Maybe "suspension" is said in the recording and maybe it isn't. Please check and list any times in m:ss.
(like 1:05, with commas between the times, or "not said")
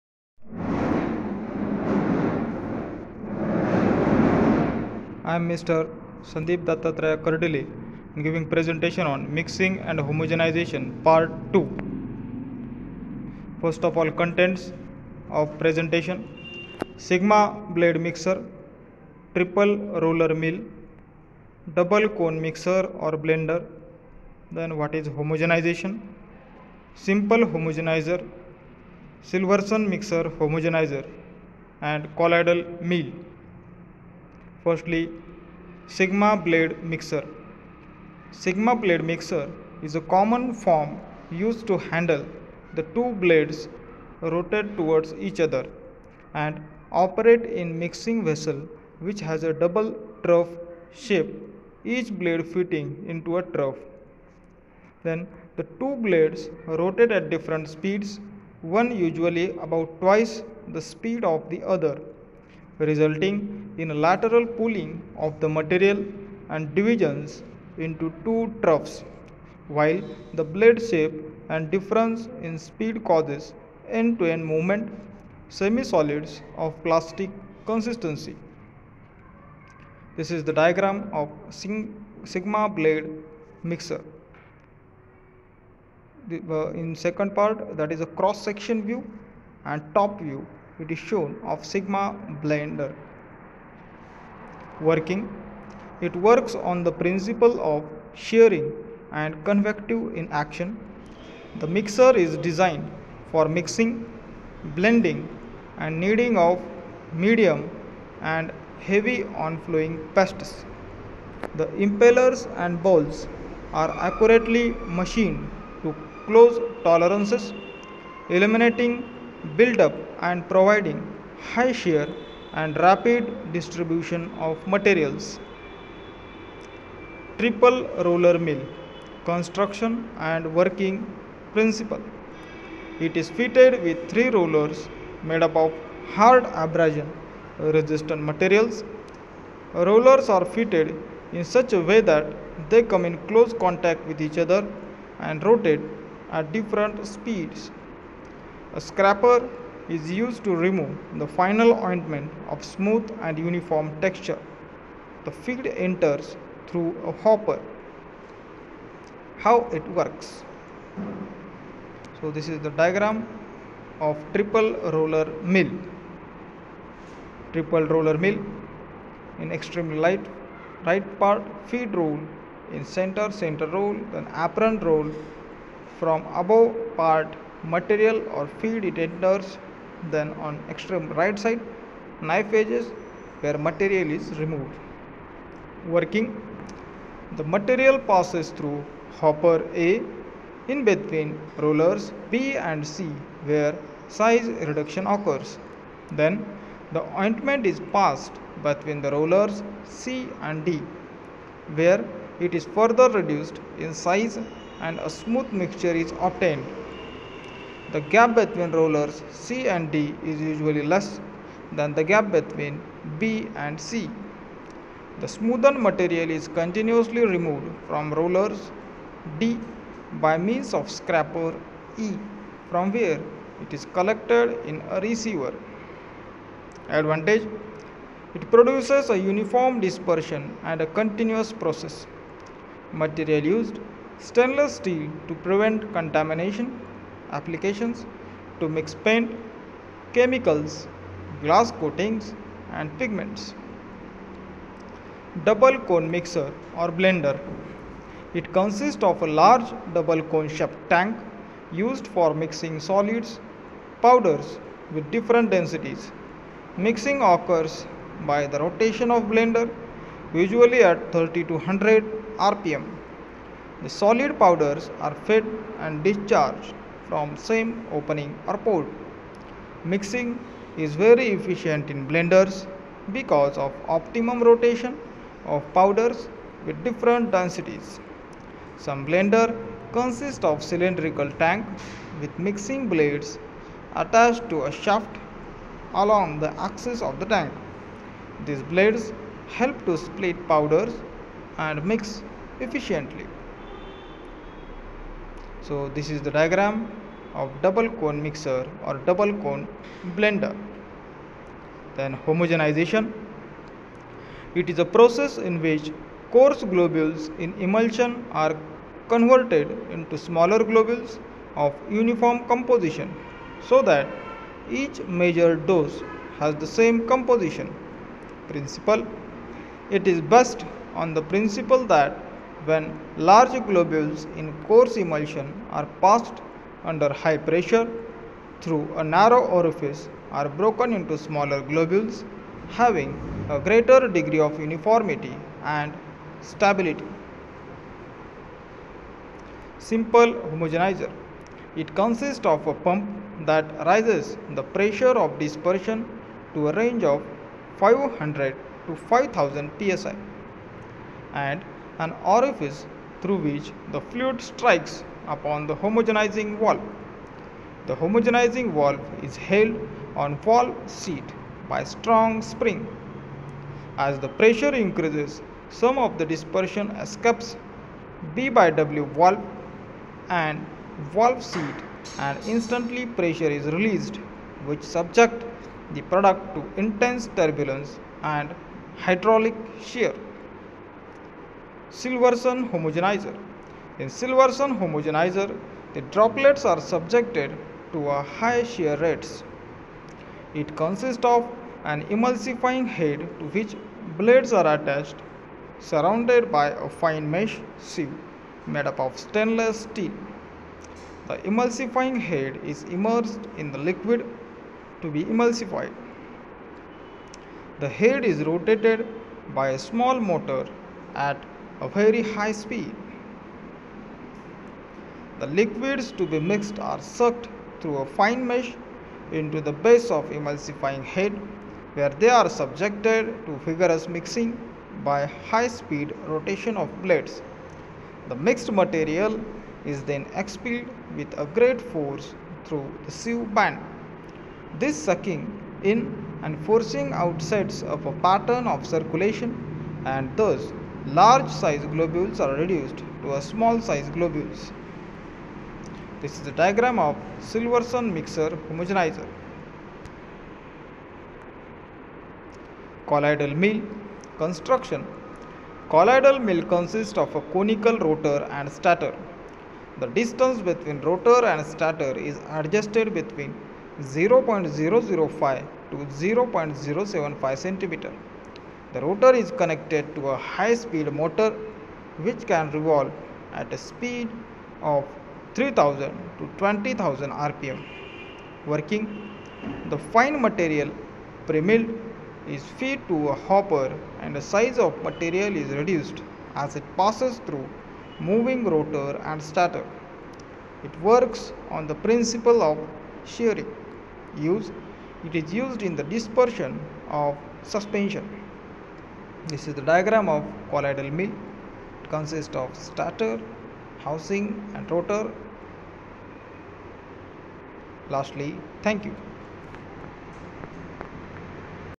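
8:17.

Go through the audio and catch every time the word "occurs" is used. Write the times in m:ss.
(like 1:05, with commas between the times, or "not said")
3:15, 4:17.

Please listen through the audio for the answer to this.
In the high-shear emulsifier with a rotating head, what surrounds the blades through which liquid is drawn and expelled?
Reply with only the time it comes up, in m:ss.
6:36.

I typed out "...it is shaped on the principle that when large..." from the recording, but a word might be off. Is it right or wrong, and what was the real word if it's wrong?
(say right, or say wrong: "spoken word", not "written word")
wrong: "based", not "shaped".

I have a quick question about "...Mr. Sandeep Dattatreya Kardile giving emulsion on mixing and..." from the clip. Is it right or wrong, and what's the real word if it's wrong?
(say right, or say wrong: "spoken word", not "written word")
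wrong: "presentation", not "emulsion".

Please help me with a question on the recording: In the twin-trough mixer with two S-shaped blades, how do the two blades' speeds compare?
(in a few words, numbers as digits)
twice.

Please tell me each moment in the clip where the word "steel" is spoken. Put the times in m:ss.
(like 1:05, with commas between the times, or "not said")
3:54, 6:39.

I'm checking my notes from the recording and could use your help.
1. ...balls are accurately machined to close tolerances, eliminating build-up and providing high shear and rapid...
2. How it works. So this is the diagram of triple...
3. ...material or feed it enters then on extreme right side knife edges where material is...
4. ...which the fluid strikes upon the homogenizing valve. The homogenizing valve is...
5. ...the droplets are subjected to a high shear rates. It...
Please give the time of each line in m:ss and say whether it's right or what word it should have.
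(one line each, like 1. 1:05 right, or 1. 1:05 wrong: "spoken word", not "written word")
1. 1:52 right
2. 2:39 right
3. 2:57 right
4. 5:53 right
5. 6:25 right.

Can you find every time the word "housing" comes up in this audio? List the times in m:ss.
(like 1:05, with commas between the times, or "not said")
8:23.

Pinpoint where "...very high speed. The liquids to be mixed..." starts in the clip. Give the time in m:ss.
6:51.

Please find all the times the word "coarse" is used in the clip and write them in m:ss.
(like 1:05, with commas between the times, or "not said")
5:06, 5:24.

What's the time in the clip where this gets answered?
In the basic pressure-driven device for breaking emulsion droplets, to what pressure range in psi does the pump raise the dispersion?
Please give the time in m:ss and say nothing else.
5:47.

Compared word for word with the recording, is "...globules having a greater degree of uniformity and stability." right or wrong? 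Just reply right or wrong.
right.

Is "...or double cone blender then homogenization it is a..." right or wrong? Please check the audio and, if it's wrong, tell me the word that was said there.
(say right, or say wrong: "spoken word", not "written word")
right.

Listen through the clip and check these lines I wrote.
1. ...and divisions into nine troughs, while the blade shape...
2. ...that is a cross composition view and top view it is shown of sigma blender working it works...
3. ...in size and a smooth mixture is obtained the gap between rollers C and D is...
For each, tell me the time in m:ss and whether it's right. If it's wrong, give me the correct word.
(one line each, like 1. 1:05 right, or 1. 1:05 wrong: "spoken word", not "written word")
1. 1:06 wrong: "two", not "nine"
2. 1:27 wrong: "section", not "composition"
3. 3:23 right.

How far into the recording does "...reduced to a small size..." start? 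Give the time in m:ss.
7:22.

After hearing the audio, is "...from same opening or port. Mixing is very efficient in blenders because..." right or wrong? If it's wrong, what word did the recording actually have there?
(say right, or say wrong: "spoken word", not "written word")
right.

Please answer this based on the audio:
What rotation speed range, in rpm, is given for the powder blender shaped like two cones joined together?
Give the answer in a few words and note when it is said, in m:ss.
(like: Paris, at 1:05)
30 to 100 rpm, at 4:21.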